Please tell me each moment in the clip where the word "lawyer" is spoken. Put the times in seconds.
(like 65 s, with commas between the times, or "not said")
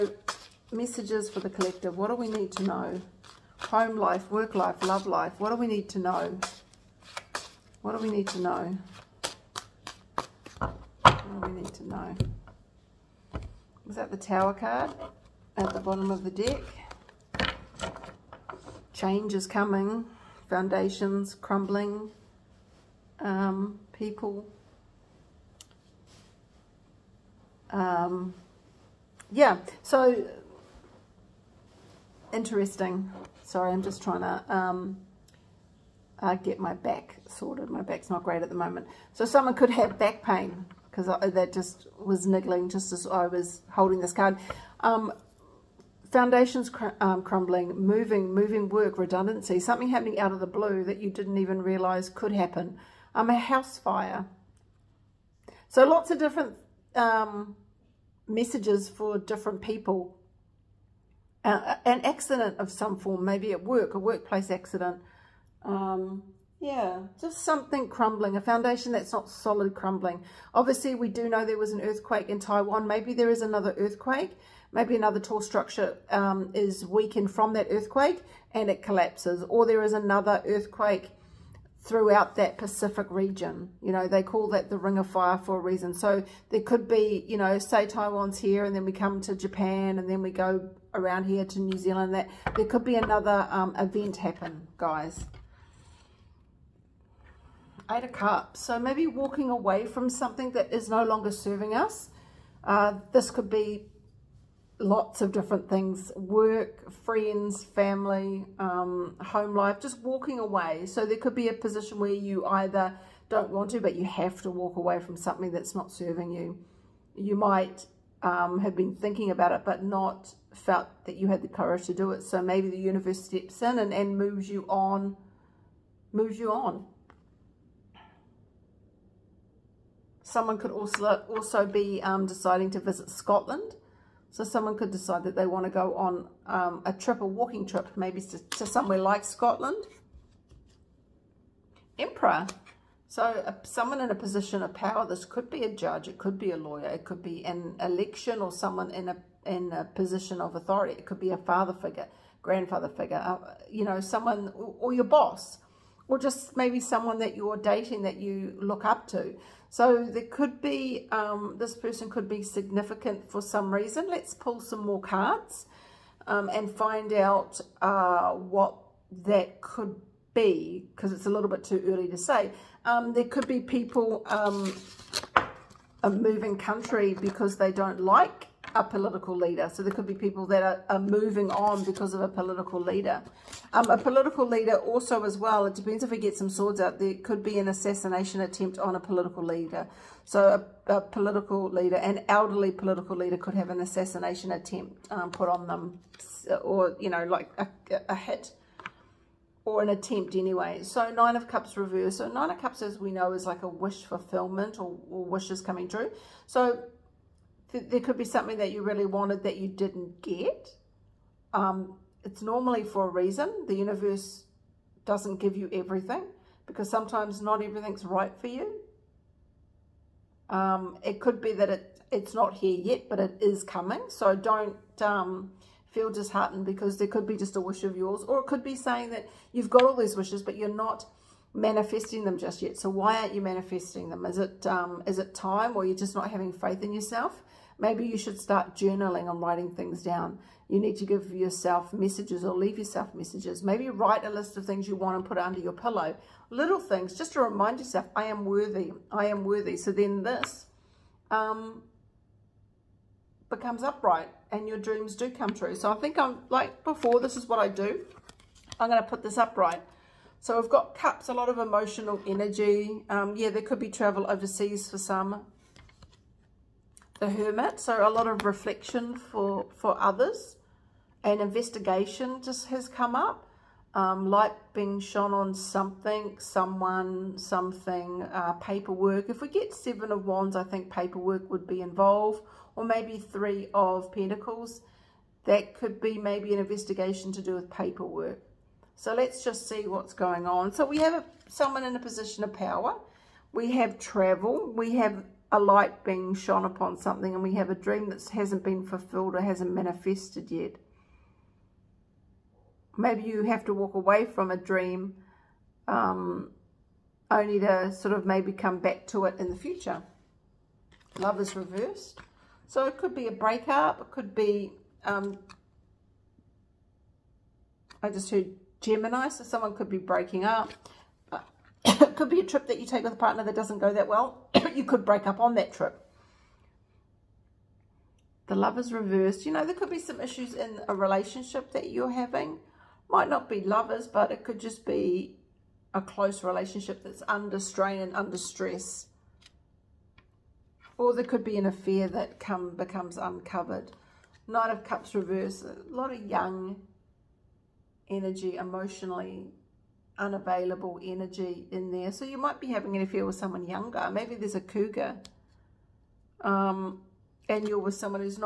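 146 s.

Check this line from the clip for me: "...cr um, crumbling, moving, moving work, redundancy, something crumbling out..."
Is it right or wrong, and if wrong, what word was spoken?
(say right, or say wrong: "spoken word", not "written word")
wrong: "happening", not "crumbling".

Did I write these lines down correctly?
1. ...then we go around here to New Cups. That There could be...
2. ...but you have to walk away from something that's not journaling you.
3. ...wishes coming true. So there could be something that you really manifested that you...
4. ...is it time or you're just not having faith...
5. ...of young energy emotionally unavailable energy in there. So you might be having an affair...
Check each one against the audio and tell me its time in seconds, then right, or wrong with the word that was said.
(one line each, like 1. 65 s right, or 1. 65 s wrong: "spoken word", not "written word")
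1. 90 s wrong: "Zealand", not "Cups"
2. 113 s wrong: "serving", not "journaling"
3. 205 s wrong: "wanted", not "manifested"
4. 235 s right
5. 346 s right.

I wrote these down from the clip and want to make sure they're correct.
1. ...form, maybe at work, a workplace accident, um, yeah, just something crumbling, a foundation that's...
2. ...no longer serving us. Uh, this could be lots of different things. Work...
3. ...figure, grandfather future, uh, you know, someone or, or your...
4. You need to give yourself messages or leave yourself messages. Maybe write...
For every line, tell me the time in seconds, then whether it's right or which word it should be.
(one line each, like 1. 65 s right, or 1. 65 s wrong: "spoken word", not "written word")
1. 62 s right
2. 100 s right
3. 151 s wrong: "figure", not "future"
4. 240 s right.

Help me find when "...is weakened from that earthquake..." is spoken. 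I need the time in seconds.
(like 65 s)
76 s.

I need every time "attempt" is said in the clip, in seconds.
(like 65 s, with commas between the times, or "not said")
188 s, 194 s, 199 s.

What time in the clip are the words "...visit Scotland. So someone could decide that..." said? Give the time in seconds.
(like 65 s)
132 s.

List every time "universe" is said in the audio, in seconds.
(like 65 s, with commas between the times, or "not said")
122 s, 213 s.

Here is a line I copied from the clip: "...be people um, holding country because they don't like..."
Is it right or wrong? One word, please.
wrong.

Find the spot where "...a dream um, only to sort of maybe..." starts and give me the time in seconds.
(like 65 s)
304 s.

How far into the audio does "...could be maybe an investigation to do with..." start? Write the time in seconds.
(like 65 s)
285 s.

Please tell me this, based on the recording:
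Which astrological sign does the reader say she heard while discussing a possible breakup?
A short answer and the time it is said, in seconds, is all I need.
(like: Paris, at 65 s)
Gemini, at 318 s.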